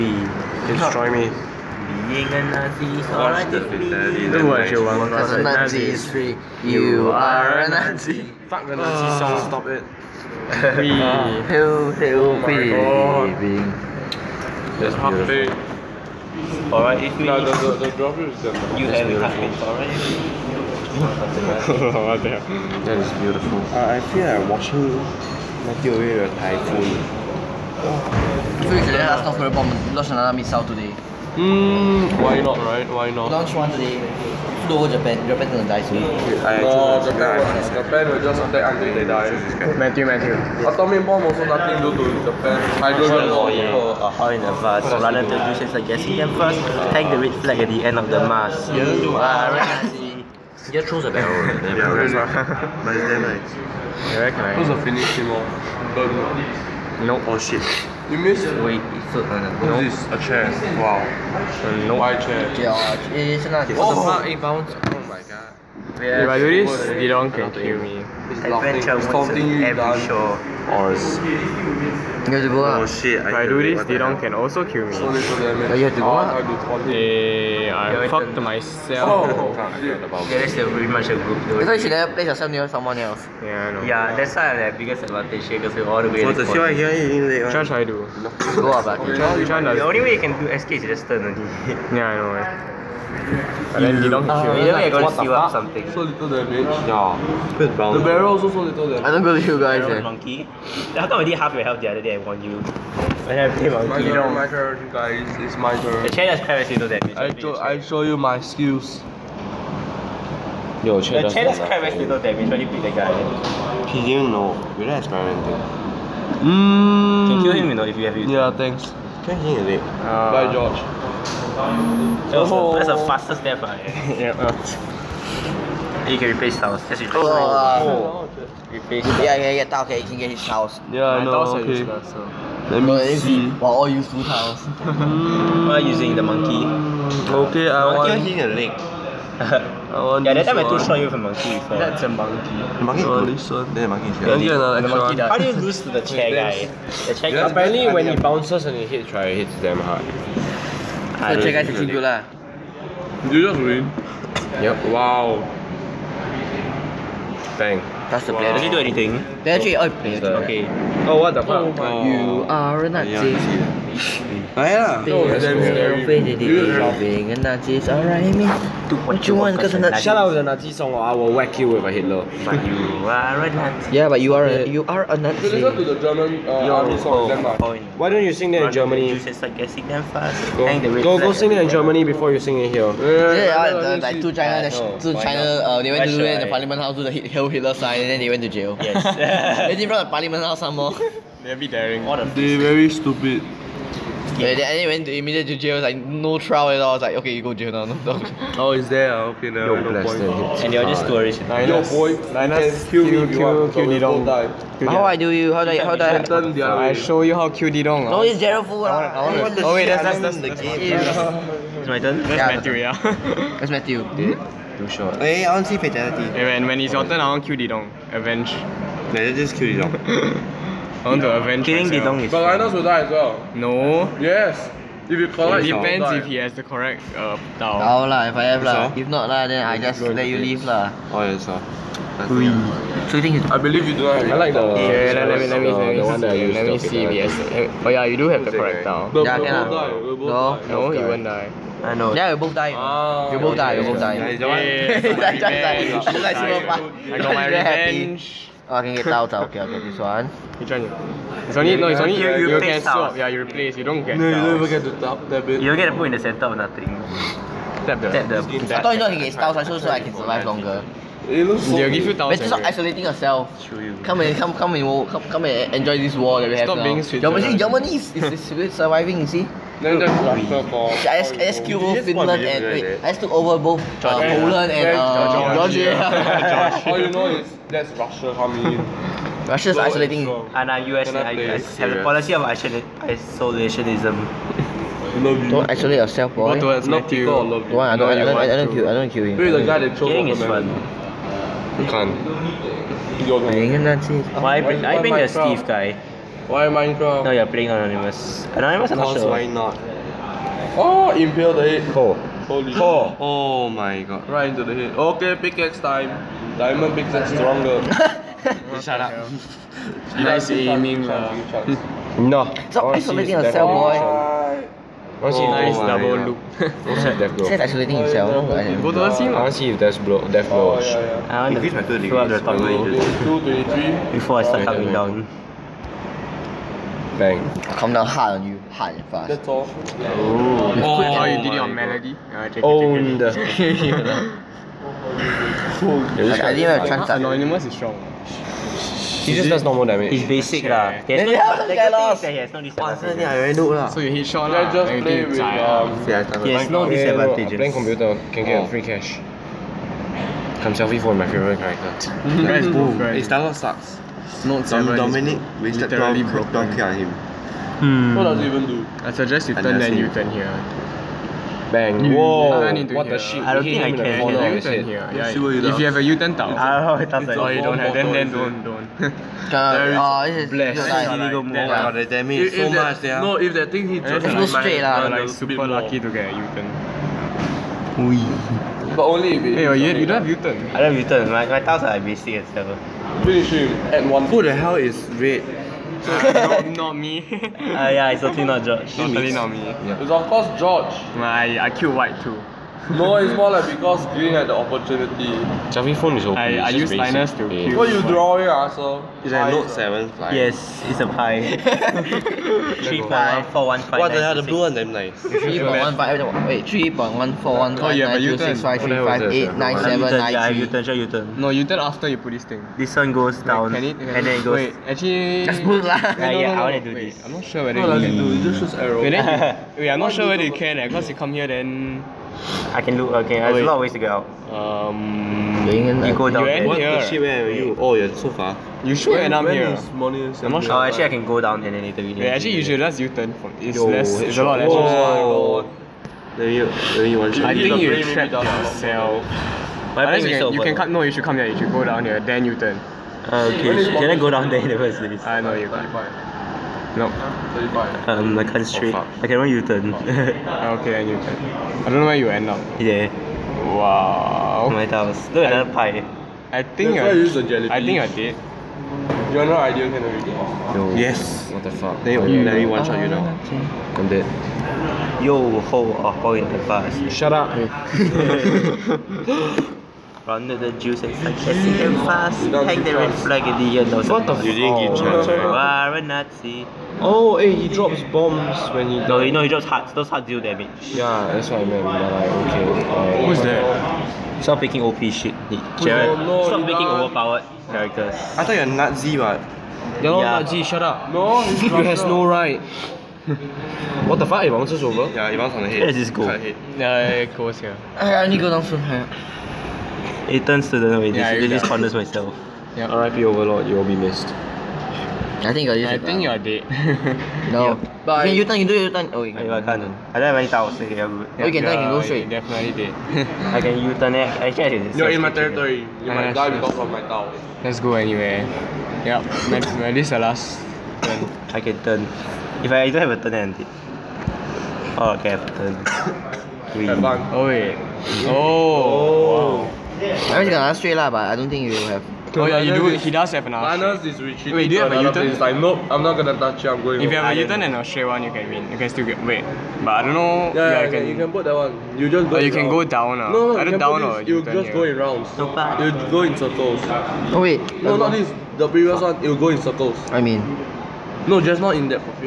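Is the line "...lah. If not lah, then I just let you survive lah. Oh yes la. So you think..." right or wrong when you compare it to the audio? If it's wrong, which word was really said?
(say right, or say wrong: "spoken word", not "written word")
wrong: "leave", not "survive".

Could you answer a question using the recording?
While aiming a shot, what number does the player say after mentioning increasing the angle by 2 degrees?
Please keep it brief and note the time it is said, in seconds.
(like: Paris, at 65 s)
223, at 323 s.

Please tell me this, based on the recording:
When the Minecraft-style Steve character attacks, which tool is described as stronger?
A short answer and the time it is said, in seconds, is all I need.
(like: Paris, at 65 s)
Diamond pickaxe, at 306 s.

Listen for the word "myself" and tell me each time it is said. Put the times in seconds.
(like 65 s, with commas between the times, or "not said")
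78 s, 221 s, 501 s.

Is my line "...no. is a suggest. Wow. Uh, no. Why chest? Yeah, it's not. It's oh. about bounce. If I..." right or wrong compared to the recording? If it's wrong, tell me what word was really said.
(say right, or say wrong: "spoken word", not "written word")
wrong: "chest", not "suggest".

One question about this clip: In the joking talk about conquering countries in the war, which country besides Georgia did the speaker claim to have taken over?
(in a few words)
Poland.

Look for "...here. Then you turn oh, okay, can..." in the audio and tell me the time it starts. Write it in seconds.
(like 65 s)
442 s.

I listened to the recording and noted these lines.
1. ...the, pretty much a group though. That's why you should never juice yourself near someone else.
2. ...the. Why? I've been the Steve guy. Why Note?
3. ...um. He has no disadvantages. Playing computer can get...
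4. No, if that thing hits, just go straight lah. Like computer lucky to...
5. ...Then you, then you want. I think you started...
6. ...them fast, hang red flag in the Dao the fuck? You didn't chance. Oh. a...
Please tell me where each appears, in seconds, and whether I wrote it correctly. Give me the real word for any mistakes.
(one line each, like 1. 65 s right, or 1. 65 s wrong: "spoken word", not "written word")
1. 80 s wrong: "place", not "juice"
2. 293 s wrong: "Minecraft", not "Note"
3. 345 s right
4. 373 s wrong: "super", not "computer"
5. 436 s wrong: "trapped", not "started"
6. 471 s wrong: "What", not "Dao".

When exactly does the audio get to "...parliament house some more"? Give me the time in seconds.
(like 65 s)
190 s.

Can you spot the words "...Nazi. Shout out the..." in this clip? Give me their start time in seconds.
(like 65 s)
169 s.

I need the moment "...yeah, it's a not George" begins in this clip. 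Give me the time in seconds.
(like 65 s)
387 s.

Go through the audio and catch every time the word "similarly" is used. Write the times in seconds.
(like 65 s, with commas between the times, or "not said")
not said.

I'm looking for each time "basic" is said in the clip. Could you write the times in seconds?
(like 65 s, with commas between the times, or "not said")
340 s, 381 s.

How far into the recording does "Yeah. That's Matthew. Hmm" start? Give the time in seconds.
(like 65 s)
212 s.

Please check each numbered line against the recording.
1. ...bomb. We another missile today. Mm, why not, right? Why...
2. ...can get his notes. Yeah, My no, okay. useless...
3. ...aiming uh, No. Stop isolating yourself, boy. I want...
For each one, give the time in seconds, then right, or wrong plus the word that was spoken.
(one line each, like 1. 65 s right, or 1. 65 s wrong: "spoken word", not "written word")
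1. 29 s right
2. 130 s wrong: "tiles", not "notes"
3. 310 s right.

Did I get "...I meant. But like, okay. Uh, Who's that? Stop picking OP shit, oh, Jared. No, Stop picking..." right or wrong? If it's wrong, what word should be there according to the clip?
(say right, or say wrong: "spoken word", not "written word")
right.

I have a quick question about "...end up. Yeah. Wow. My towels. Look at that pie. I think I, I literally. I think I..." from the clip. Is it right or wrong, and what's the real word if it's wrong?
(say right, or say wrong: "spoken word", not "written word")
wrong: "jelly", not "literally".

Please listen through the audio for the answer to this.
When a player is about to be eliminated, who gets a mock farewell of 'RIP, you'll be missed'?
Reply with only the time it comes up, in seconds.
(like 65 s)
503 s.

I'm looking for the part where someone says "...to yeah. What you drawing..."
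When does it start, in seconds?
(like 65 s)
397 s.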